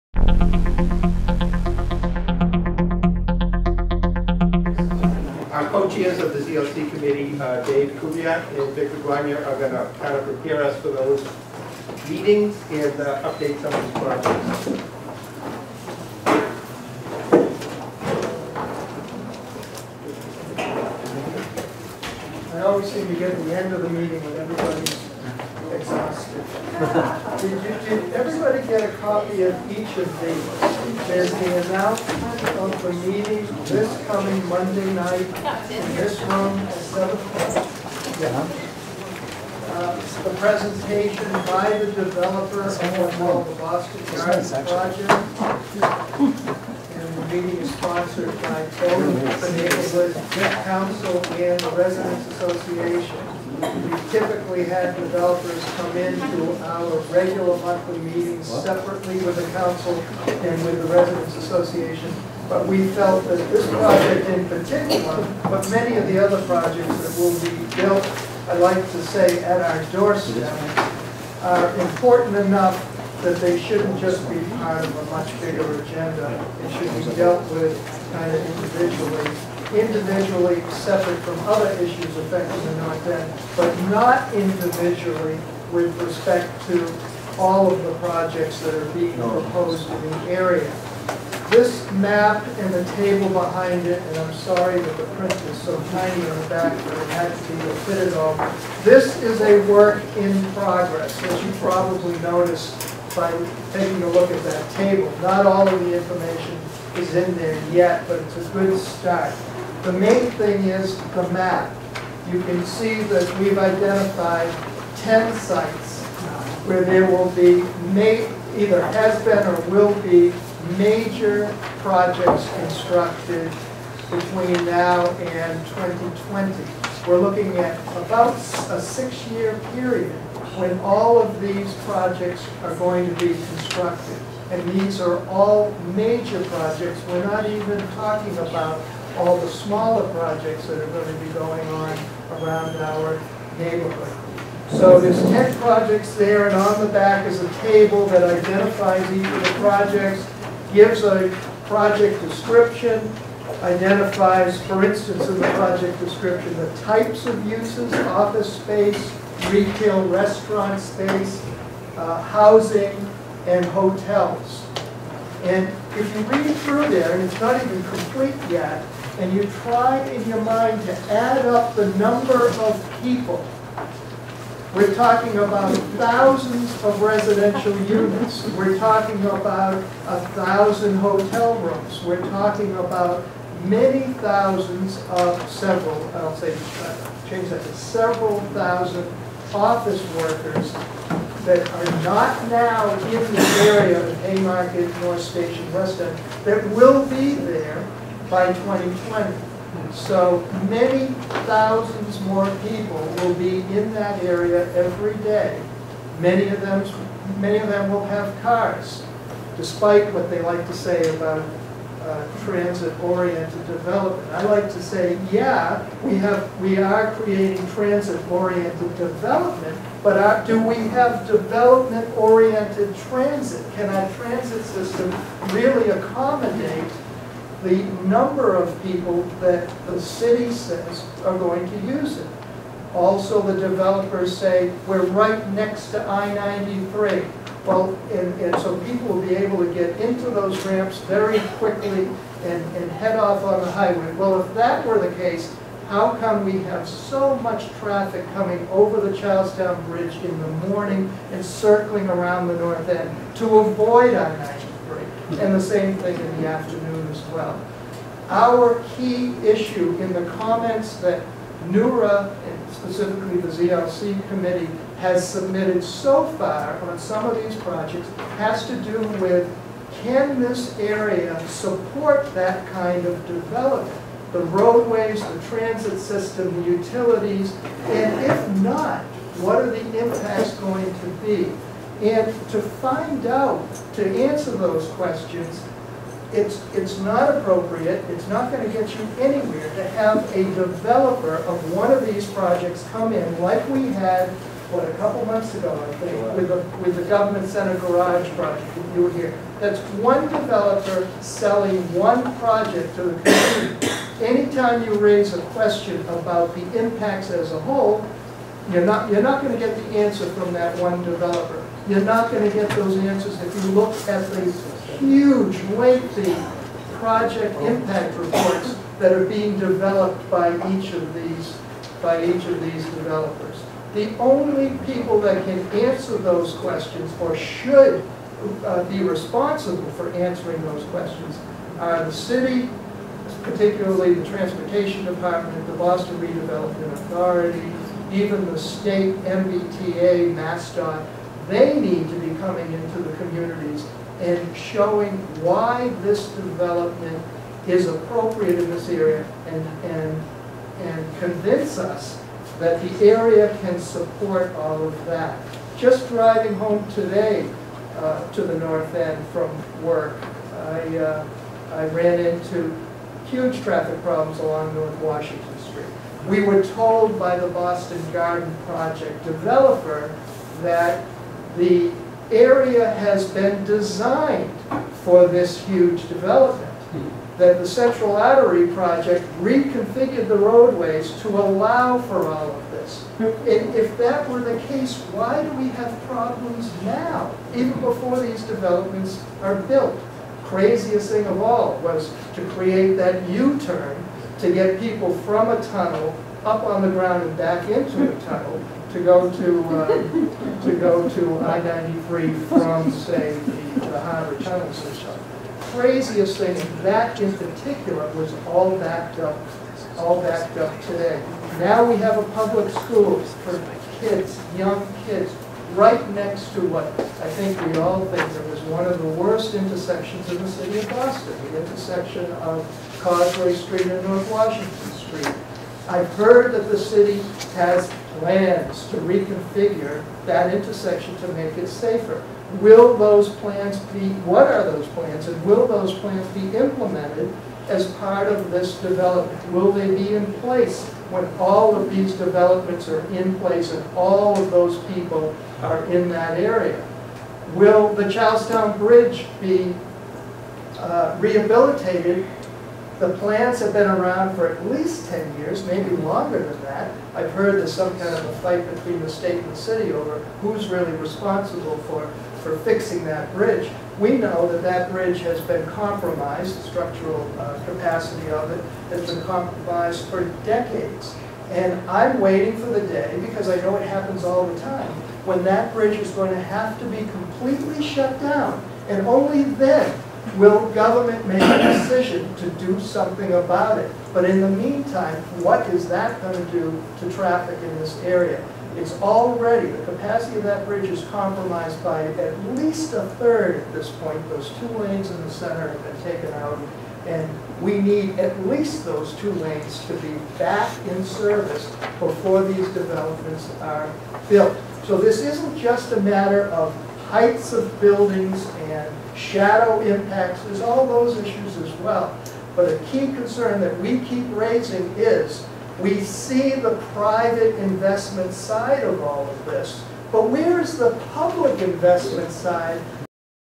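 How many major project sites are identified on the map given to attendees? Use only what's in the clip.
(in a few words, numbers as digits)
10.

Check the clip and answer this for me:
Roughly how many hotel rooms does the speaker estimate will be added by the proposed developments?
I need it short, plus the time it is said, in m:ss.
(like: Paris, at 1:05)
a thousand, at 3:00.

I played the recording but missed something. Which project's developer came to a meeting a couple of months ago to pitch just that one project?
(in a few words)
government center garage.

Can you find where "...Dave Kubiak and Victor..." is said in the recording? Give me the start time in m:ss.
0:07.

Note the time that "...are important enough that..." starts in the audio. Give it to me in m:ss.
1:11.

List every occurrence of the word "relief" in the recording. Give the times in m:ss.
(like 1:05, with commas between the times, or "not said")
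not said.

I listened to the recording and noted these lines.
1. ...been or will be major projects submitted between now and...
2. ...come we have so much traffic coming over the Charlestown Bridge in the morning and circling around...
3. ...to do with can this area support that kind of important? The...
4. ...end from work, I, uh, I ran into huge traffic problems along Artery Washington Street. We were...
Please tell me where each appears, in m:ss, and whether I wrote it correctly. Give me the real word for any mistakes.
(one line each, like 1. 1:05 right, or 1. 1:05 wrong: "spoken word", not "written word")
1. 1:59 wrong: "constructed", not "submitted"
2. 4:06 right
3. 4:28 wrong: "development", not "important"
4. 5:58 wrong: "North", not "Artery".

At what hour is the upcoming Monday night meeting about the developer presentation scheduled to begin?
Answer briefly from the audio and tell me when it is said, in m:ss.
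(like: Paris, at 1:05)
7 o'clock, at 0:36.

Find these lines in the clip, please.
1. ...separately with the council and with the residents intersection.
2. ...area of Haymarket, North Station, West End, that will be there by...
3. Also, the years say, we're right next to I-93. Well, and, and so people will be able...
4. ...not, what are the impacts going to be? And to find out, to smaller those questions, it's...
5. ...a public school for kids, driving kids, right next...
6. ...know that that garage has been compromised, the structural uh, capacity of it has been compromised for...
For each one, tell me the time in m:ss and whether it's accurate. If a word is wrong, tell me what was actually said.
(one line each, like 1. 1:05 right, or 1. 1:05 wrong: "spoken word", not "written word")
1. 0:58 wrong: "association", not "intersection"
2. 3:13 right
3. 3:52 wrong: "developers", not "years"
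4. 4:38 wrong: "answer", not "smaller"
5. 6:52 wrong: "young", not "driving"
6. 7:44 wrong: "bridge", not "garage".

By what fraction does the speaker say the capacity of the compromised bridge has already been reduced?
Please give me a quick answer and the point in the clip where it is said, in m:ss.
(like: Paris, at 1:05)
at least a third, at 8:12.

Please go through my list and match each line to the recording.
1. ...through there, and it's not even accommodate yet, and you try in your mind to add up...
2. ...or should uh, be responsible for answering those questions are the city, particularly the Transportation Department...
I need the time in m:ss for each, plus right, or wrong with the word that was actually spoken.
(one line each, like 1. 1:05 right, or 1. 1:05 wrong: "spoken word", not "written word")
1. 2:46 wrong: "complete", not "accommodate"
2. 5:27 right.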